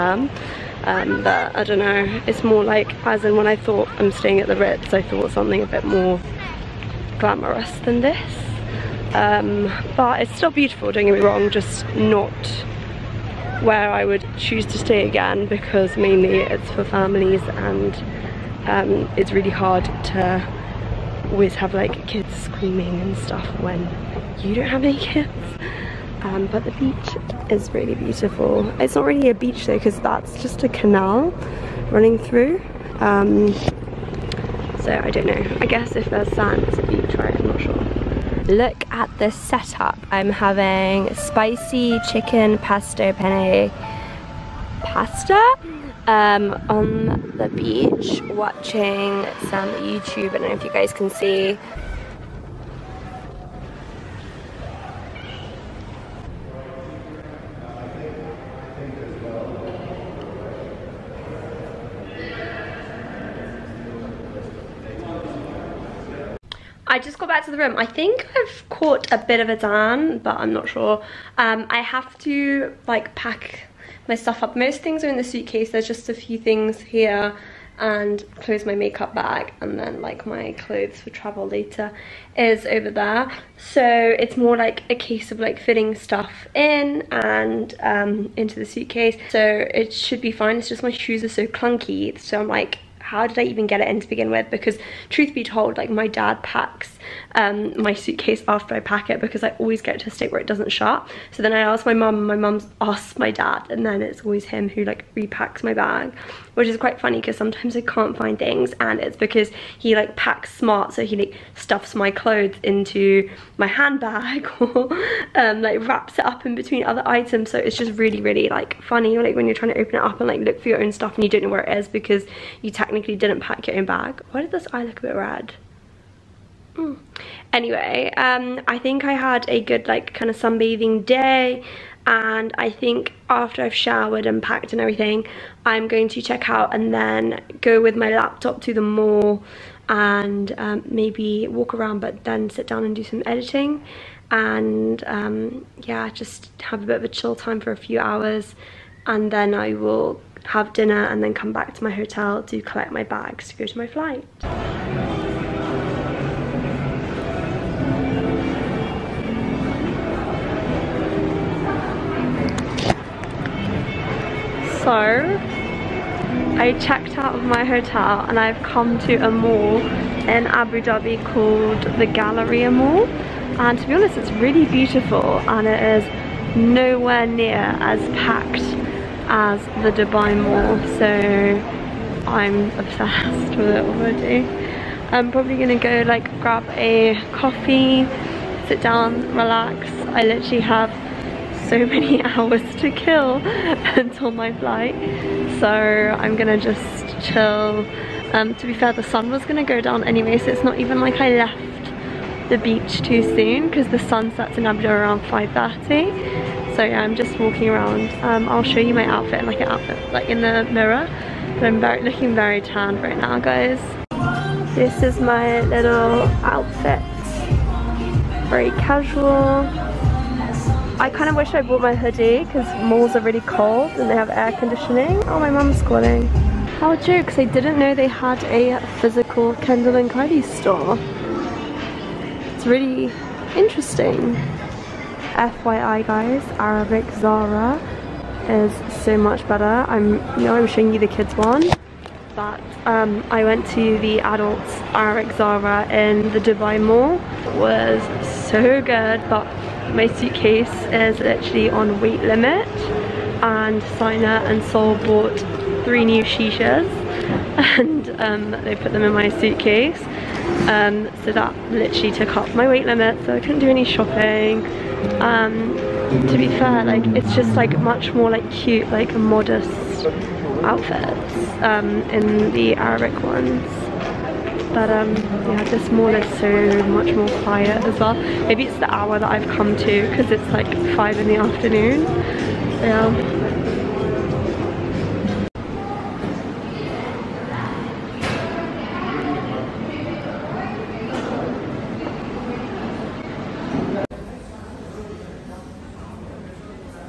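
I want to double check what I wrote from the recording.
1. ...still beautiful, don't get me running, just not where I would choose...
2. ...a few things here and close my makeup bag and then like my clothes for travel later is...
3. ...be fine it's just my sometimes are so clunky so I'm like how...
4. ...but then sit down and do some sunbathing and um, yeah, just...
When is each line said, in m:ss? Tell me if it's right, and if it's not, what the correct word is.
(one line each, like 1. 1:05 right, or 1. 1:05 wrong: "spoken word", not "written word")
1. 0:10 wrong: "wrong", not "running"
2. 1:16 right
3. 1:30 wrong: "shoes", not "sometimes"
4. 2:21 wrong: "editing", not "sunbathing".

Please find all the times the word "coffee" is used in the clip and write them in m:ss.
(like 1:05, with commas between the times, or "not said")
3:07.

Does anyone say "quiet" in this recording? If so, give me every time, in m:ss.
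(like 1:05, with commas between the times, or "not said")
4:37.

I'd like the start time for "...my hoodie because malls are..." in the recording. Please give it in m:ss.
3:41.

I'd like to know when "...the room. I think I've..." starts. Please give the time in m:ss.
1:07.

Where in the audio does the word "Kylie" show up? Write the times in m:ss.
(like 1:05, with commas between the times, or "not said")
3:50.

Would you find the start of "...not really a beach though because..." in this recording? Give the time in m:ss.
0:28.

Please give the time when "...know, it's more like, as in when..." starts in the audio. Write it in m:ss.
0:01.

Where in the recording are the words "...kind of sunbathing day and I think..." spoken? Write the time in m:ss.
2:10.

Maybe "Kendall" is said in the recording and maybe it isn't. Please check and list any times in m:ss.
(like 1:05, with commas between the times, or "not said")
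3:49.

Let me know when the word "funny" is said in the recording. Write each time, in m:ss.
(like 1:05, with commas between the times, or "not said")
1:46, 1:58.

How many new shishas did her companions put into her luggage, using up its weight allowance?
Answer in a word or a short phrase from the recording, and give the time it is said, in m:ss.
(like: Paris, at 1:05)
3, at 4:15.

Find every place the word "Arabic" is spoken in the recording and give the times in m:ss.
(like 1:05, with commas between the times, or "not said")
3:56, 4:04, 4:32.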